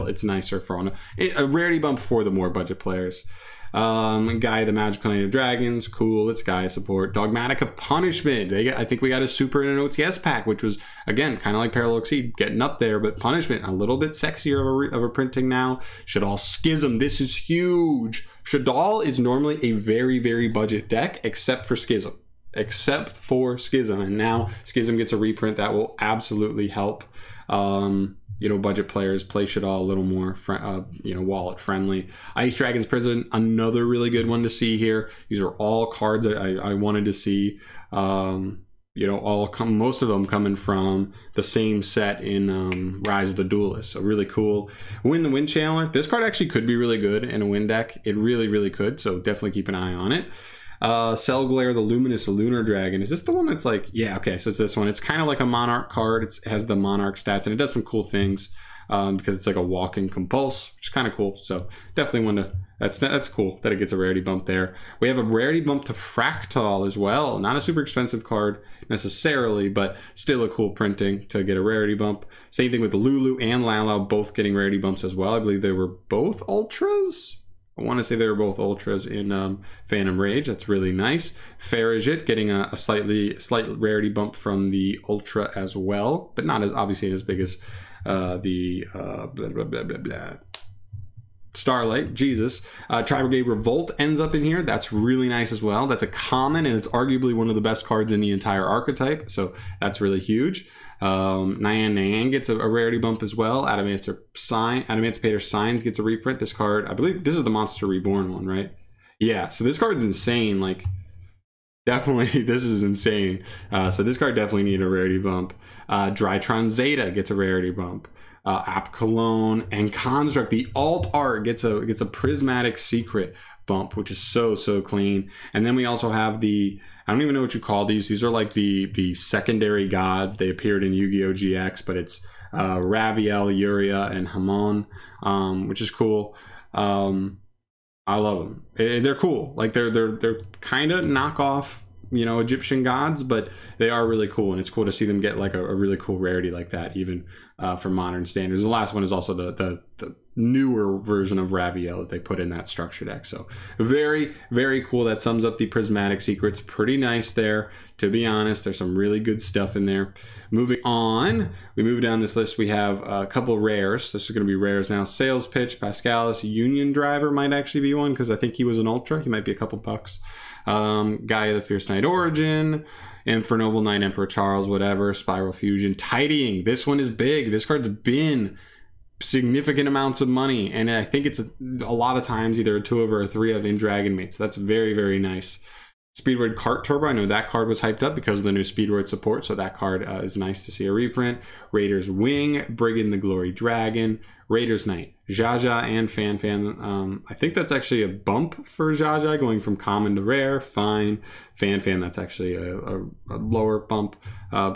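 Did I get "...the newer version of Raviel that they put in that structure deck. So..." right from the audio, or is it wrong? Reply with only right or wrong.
right.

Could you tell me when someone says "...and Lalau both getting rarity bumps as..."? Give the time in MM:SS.
01:13.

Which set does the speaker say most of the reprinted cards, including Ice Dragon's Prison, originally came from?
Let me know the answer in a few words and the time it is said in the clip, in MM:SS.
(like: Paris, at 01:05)
Rise of the Duelist, at 00:43.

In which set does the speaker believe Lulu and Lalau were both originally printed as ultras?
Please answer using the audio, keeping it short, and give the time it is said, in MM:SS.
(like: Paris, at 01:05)
Phantom Rage, at 01:19.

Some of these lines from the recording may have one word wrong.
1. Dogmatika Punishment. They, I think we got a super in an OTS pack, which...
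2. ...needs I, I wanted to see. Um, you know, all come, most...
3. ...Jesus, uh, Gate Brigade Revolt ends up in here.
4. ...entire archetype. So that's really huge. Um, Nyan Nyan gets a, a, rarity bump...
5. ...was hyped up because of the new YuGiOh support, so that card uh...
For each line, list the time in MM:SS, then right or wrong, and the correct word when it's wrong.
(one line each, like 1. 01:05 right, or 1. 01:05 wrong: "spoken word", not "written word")
1. 00:07 right
2. 00:35 wrong: "cards", not "needs"
3. 01:32 right
4. 01:38 right
5. 03:07 wrong: "Speedroid", not "YuGiOh".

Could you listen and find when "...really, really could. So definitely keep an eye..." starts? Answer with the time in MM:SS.
00:48.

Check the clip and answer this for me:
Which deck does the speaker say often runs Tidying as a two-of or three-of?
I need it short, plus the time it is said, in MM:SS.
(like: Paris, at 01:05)
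Dragon Maids, at 03:03.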